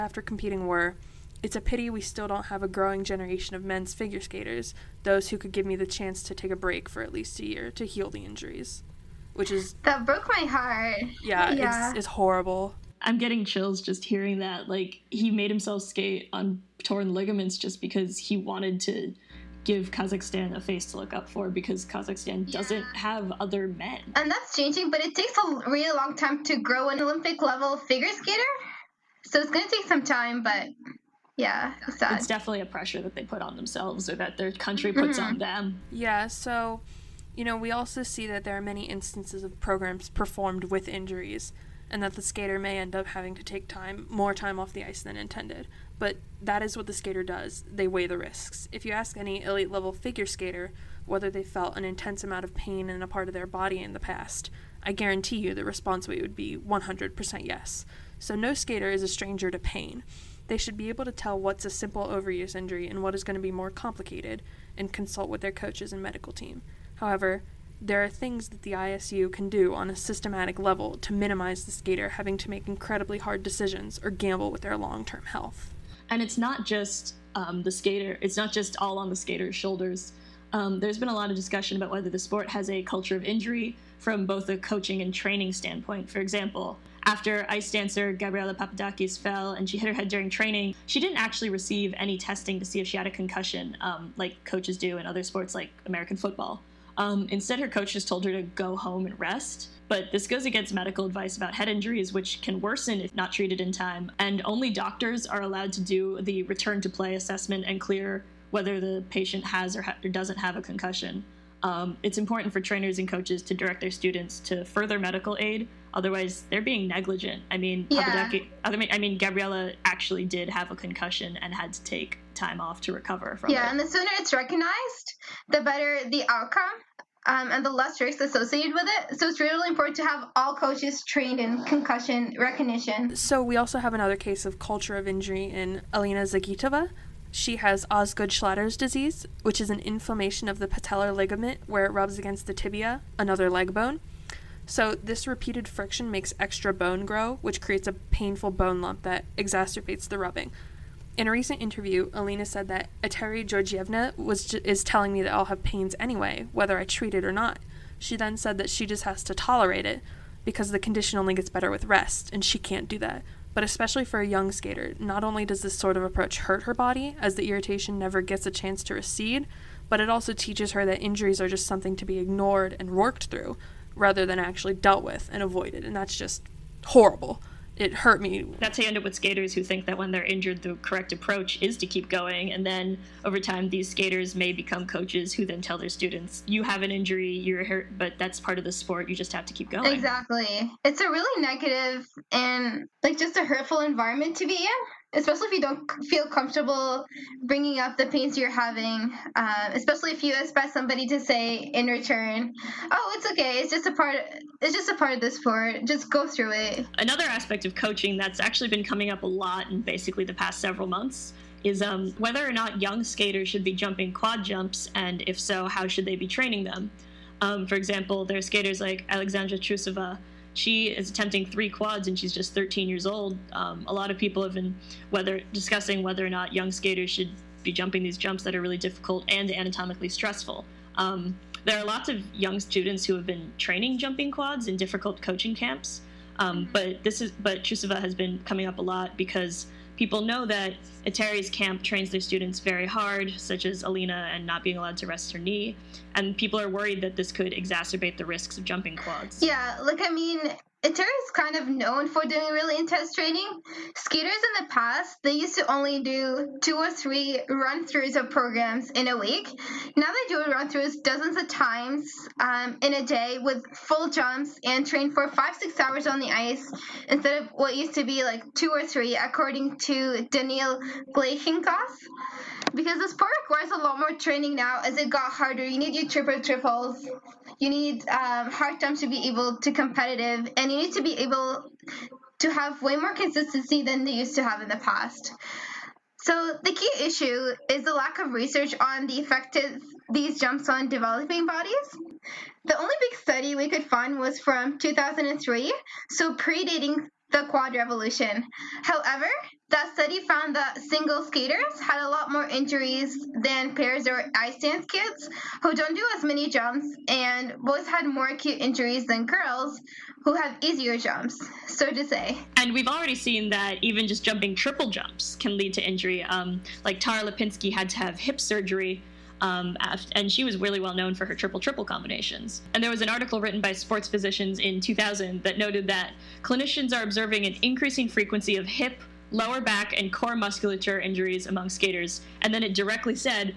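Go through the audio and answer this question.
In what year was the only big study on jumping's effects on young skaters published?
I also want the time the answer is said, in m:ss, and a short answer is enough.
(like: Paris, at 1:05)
2003, at 4:54.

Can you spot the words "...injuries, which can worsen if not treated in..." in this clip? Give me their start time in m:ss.
1:41.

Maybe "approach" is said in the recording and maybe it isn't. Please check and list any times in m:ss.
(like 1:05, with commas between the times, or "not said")
2:46, 3:01.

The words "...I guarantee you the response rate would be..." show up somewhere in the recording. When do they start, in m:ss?
0:54.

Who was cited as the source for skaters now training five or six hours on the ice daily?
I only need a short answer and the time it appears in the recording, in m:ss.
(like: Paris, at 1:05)
Daniil Gleikhengauz, at 4:30.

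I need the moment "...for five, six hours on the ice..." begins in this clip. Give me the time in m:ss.
4:25.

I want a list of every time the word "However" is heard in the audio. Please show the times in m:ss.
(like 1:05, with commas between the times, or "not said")
1:06, 4:58.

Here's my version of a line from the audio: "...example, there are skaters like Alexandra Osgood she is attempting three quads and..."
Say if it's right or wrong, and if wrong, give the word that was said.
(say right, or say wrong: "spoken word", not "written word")
wrong: "Trusova", not "Osgood".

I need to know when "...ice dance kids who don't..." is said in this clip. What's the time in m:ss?
5:04.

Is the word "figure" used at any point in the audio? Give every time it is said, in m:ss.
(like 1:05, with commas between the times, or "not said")
0:03, 0:27, 0:49.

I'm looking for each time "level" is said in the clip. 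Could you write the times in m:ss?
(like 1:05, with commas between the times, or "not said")
0:27, 0:49, 1:10.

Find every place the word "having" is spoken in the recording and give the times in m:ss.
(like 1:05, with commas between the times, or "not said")
0:43, 1:12, 3:18.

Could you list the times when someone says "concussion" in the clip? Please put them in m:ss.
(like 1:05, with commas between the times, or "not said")
1:33, 1:50, 2:00, 2:11.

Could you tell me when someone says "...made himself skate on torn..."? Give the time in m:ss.
0:15.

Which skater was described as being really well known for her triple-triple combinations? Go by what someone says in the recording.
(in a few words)
Tara Lipinski.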